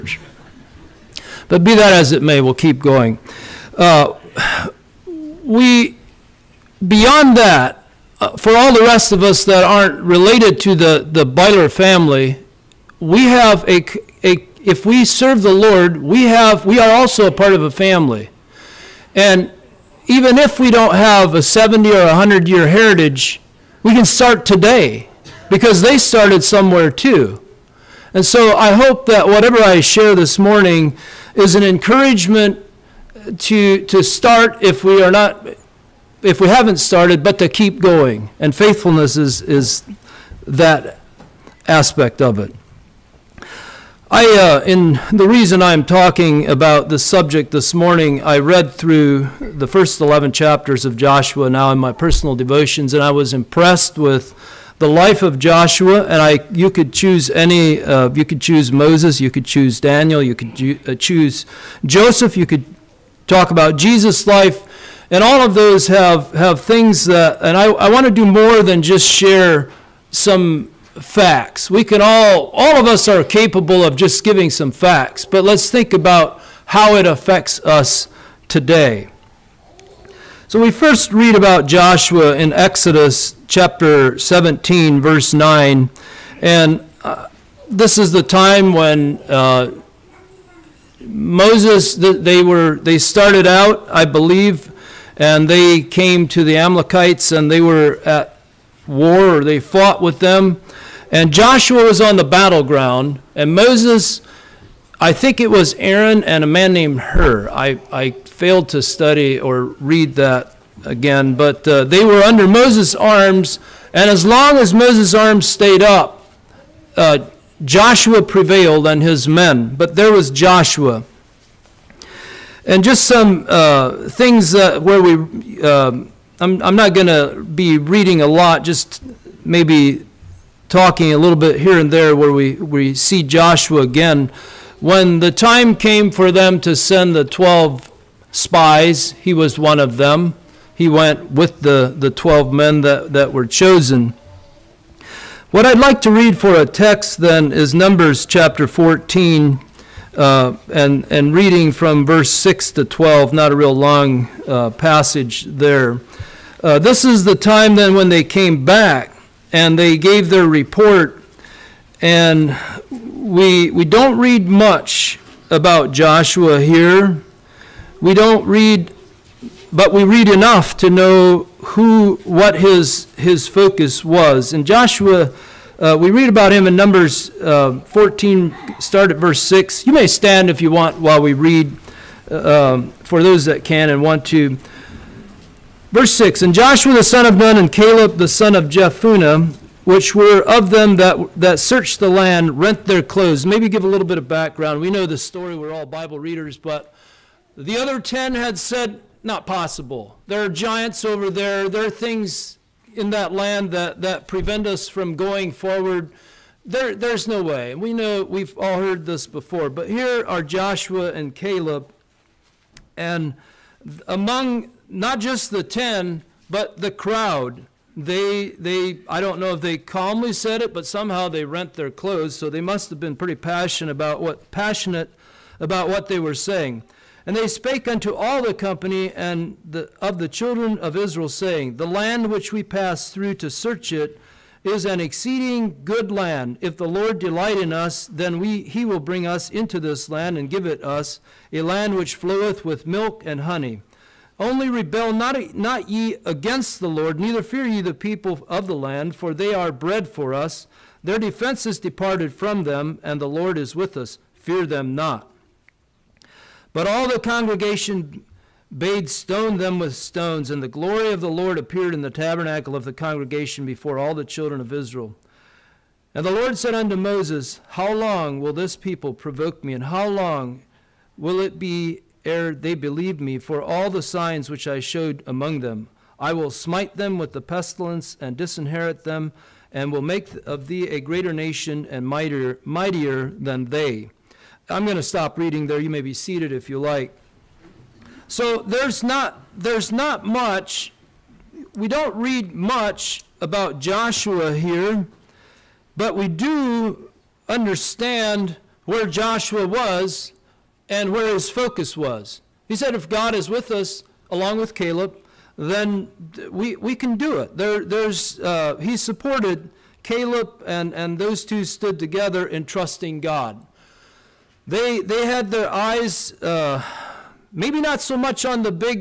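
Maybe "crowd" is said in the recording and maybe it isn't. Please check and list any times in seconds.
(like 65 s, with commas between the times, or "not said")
216 s.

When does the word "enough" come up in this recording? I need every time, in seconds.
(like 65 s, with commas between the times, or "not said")
170 s.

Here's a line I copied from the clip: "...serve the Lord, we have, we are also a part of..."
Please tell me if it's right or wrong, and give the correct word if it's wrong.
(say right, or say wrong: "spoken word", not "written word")
right.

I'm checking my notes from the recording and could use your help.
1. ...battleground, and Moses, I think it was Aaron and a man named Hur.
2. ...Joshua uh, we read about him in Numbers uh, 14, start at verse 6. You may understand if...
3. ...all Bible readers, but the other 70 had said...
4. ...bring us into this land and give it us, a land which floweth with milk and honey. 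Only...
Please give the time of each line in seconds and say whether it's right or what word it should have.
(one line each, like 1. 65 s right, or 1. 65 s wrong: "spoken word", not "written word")
1. 102 s right
2. 174 s wrong: "stand", not "understand"
3. 195 s wrong: "10", not "70"
4. 238 s right.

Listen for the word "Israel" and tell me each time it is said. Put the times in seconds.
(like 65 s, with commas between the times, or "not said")
230 s, 264 s.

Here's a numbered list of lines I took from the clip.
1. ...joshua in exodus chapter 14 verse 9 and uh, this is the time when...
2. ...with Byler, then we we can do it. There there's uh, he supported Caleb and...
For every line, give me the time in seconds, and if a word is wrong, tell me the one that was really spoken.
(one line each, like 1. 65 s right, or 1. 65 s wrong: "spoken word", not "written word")
1. 81 s wrong: "17", not "14"
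2. 304 s wrong: "Caleb", not "Byler".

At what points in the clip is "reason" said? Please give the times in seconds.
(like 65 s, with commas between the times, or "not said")
45 s.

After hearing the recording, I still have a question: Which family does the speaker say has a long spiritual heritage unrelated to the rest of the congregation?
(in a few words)
Byler.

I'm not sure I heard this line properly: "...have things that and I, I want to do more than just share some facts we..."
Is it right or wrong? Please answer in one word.
right.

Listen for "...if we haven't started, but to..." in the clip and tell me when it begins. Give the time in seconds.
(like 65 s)
36 s.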